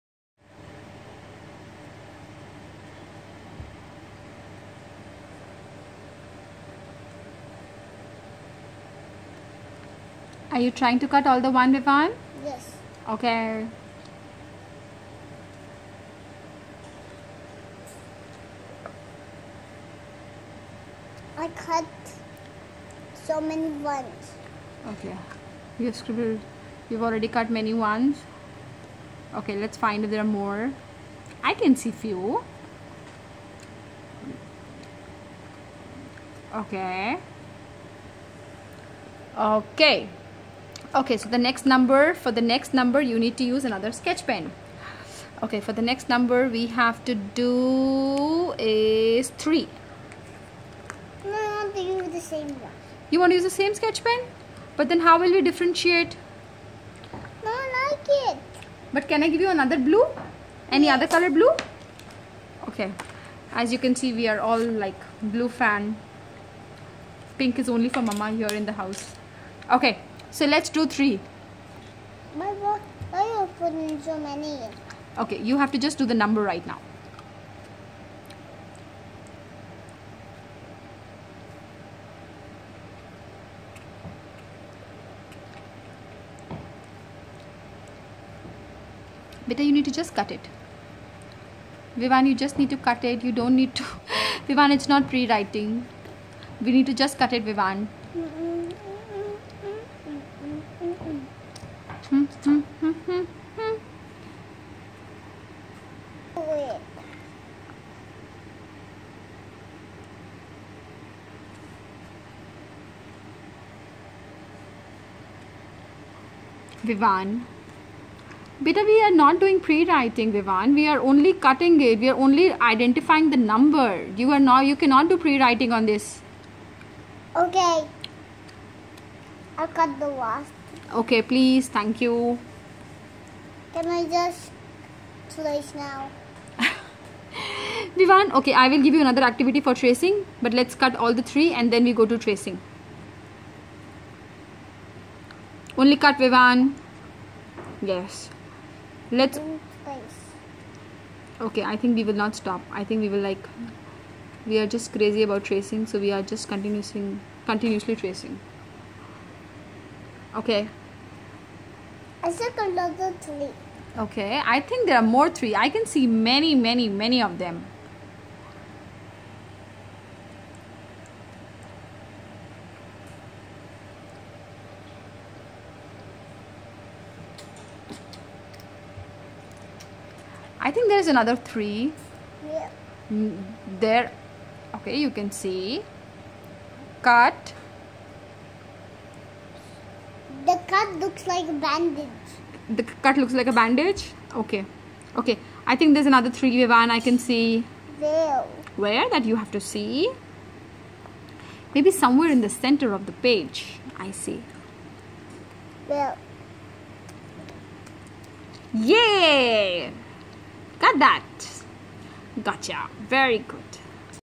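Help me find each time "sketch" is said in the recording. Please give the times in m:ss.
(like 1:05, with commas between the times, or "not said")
0:43, 0:53.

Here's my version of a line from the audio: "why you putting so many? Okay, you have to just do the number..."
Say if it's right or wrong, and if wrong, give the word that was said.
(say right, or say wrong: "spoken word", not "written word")
right.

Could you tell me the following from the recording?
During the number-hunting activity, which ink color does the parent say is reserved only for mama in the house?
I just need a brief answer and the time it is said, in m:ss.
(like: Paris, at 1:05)
Pink, at 1:07.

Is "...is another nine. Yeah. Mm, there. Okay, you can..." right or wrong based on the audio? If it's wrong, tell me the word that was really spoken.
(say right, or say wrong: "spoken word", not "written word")
wrong: "three", not "nine".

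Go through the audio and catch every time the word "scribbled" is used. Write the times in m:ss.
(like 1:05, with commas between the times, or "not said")
0:25.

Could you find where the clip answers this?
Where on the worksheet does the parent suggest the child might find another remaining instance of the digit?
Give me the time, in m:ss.
3:22.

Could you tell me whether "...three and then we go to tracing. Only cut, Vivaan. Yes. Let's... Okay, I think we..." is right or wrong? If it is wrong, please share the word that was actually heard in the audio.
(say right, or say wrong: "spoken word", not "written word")
right.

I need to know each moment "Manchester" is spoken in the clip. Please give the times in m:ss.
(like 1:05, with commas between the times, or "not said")
not said.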